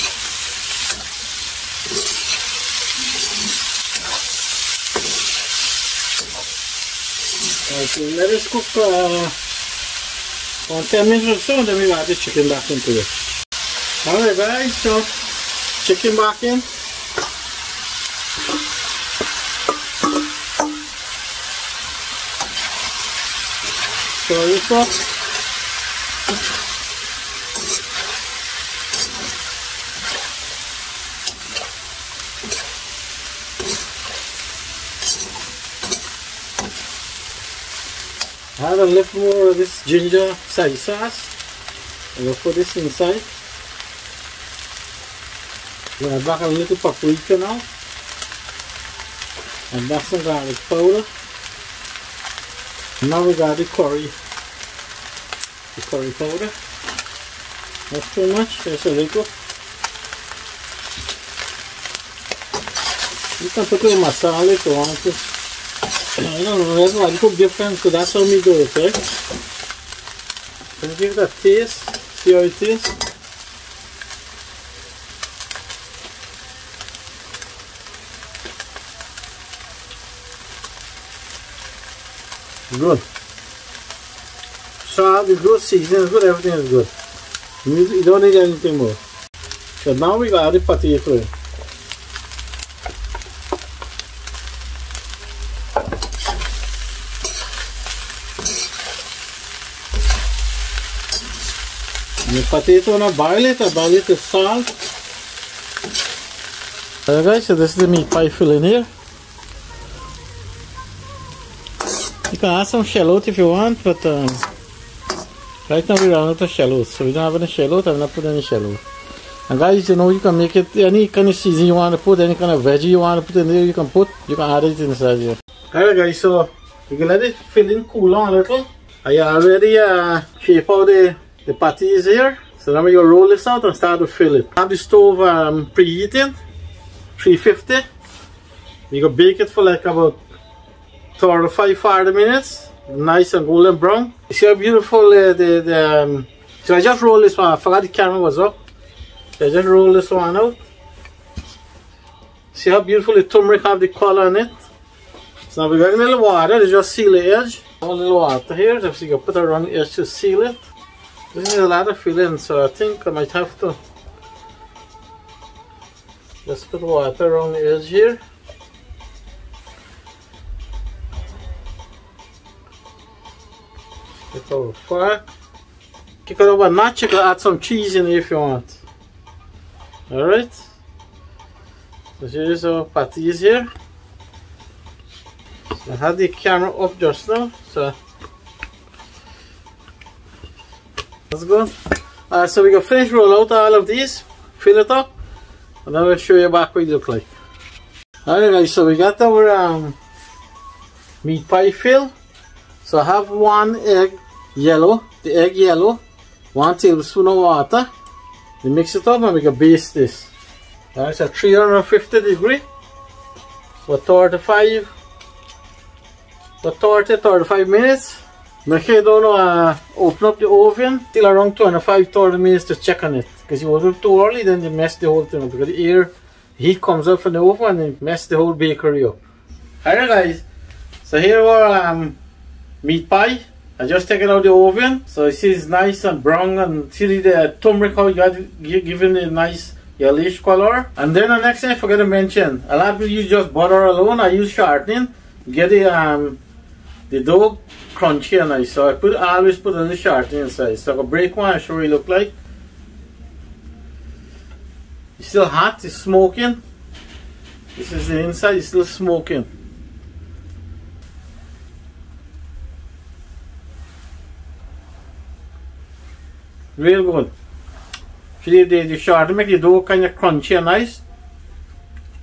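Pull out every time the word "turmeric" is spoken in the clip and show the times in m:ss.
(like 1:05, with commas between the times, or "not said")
2:33, 3:57.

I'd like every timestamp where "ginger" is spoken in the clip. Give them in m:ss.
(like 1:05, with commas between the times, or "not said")
0:39.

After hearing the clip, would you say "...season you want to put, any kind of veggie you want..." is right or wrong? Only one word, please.
right.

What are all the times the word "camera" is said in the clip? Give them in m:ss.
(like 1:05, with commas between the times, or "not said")
2:27, 3:06.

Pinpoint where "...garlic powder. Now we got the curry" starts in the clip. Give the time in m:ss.
0:50.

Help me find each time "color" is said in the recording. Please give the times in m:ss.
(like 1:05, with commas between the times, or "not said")
2:33, 4:00.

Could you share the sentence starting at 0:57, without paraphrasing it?
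Not too much, just a little.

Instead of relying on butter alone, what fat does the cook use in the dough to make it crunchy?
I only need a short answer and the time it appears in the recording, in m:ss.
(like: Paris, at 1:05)
Shortening, at 4:04.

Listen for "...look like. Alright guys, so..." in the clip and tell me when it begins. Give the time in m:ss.
3:16.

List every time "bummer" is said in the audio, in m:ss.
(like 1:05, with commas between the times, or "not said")
not said.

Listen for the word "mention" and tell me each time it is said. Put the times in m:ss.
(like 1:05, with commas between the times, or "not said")
4:02.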